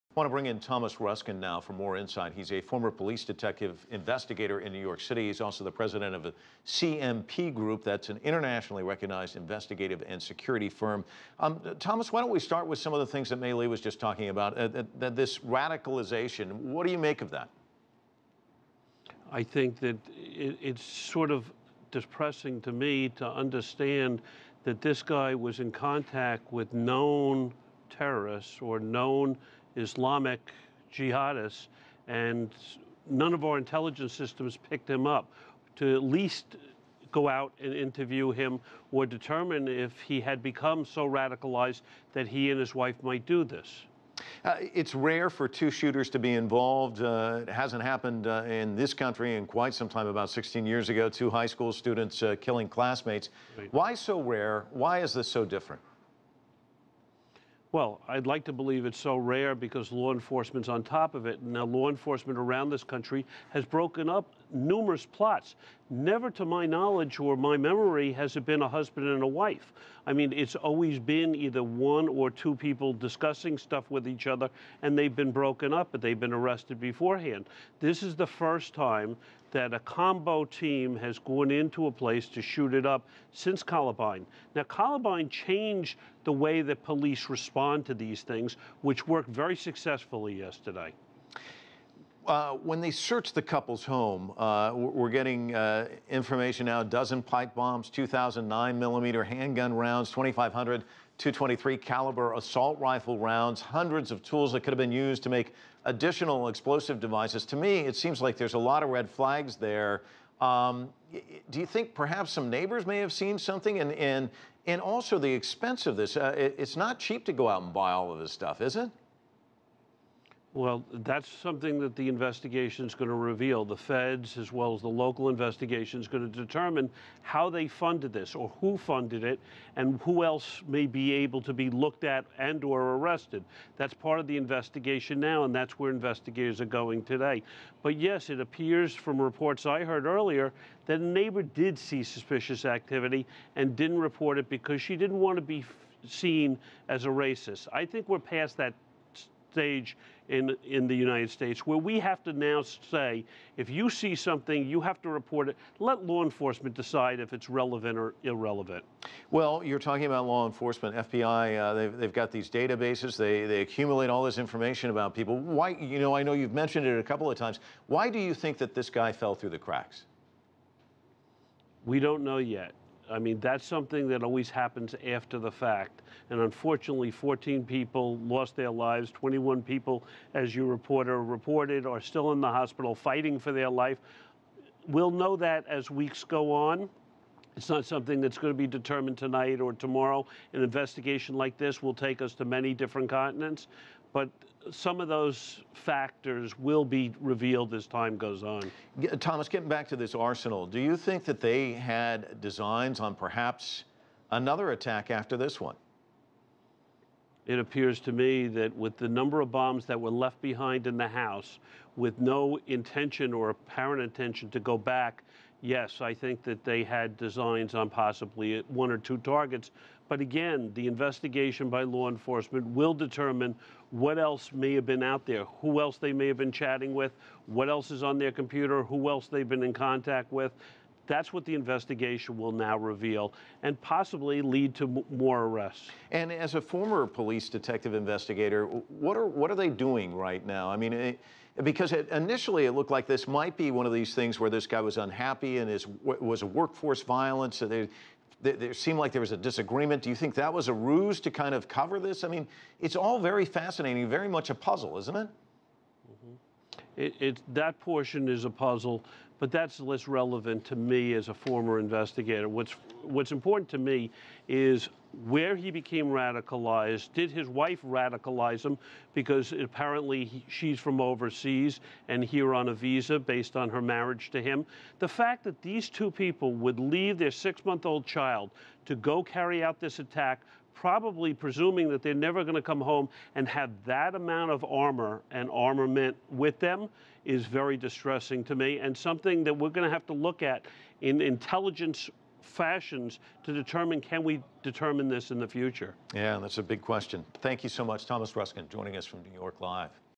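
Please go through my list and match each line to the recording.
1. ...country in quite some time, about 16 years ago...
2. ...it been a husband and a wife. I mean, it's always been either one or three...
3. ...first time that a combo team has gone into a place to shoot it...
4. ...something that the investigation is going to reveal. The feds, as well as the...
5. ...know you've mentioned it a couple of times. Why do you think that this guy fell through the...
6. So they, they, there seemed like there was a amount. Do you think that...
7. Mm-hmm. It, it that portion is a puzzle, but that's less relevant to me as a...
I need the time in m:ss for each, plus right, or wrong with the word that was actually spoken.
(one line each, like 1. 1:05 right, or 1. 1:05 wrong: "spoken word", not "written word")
1. 0:48 right
2. 1:08 wrong: "two", not "three"
3. 1:18 right
4. 2:01 right
5. 2:46 right
6. 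4:07 wrong: "disagreement", not "amount"
7. 4:16 right.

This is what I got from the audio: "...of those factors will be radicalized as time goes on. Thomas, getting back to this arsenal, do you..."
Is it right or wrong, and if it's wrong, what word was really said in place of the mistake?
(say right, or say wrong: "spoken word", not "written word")
wrong: "revealed", not "radicalized".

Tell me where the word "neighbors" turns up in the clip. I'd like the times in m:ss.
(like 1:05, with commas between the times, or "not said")
1:52, 2:21.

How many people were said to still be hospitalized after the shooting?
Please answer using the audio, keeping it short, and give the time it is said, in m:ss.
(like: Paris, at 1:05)
21, at 2:59.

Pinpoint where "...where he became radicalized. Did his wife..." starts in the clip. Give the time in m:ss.
4:25.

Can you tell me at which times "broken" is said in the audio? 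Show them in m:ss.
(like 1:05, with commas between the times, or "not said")
1:03, 1:15.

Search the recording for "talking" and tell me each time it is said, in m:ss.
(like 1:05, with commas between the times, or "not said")
0:14, 2:39.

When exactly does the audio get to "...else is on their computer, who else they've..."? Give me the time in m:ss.
3:47.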